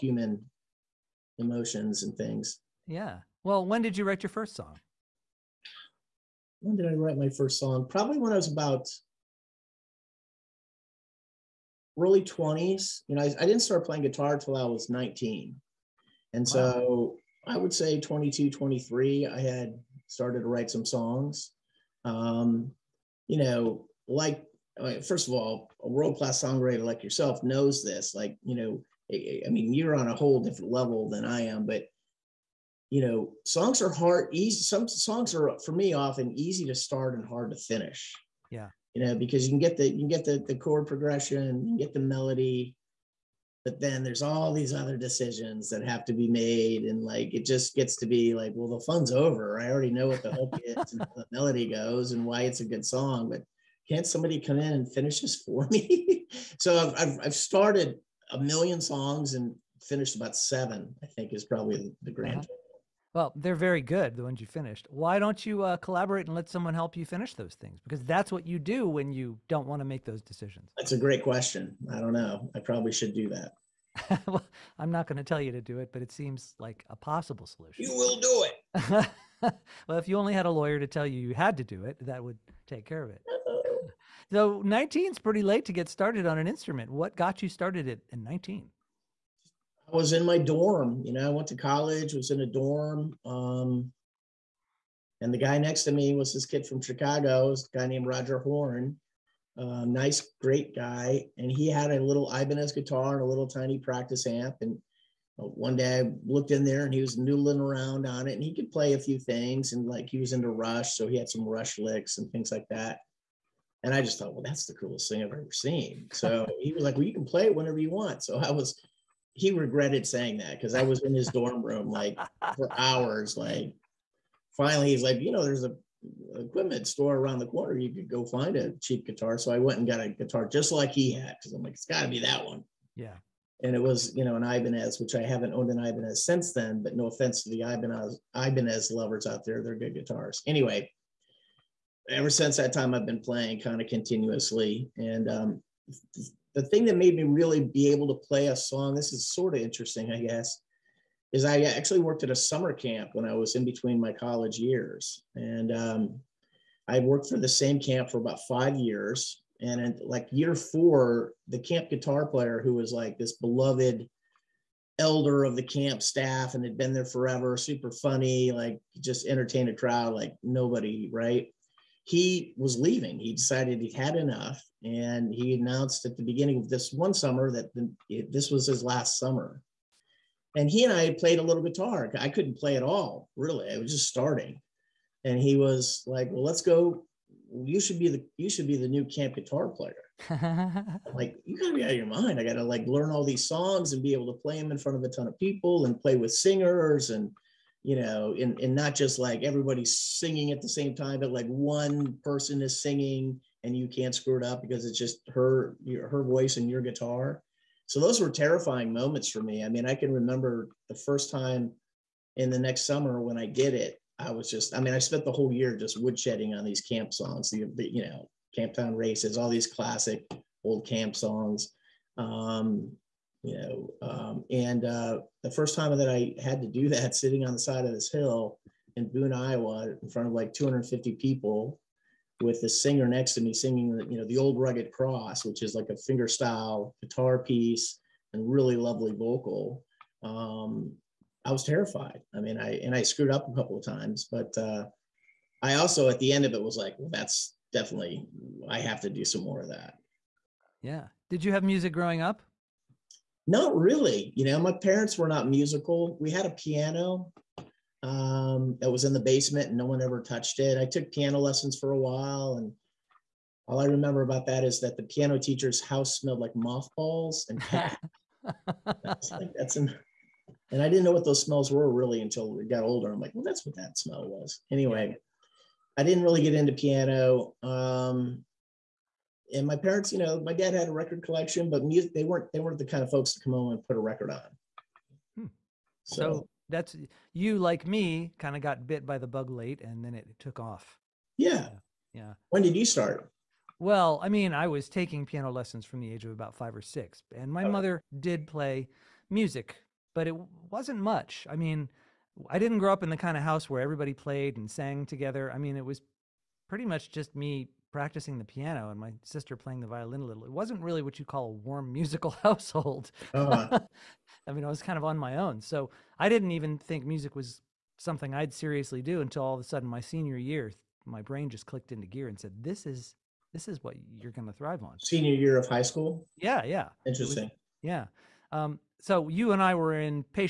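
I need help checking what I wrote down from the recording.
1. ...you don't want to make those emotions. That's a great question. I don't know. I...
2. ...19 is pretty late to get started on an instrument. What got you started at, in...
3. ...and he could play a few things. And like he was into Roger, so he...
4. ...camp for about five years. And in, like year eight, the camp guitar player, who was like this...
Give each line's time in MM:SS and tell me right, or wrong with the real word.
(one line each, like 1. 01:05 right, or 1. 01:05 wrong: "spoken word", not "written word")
1. 01:09 wrong: "decisions", not "emotions"
2. 01:24 right
3. 01:48 wrong: "Rush", not "Roger"
4. 02:37 wrong: "four", not "eight".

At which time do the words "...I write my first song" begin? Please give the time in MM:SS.
00:06.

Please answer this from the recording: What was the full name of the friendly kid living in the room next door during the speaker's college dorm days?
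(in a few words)
Roger Horn.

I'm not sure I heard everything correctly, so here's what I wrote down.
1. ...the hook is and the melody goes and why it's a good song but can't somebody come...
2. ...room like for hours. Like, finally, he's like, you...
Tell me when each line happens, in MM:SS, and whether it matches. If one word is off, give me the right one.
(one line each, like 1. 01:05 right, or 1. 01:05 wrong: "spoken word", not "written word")
1. 00:50 right
2. 02:01 right.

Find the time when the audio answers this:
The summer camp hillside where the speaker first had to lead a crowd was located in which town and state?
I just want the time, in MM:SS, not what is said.
03:49.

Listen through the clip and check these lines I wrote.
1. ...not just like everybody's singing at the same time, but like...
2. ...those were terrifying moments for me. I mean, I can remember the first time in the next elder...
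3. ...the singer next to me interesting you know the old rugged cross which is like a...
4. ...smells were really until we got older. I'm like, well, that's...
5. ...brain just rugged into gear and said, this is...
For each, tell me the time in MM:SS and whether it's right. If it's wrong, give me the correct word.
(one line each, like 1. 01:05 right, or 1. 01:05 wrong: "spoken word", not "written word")
1. 03:18 right
2. 03:27 wrong: "summer", not "elder"
3. 03:52 wrong: "singing", not "interesting"
4. 04:31 right
5. 05:21 wrong: "clicked", not "rugged".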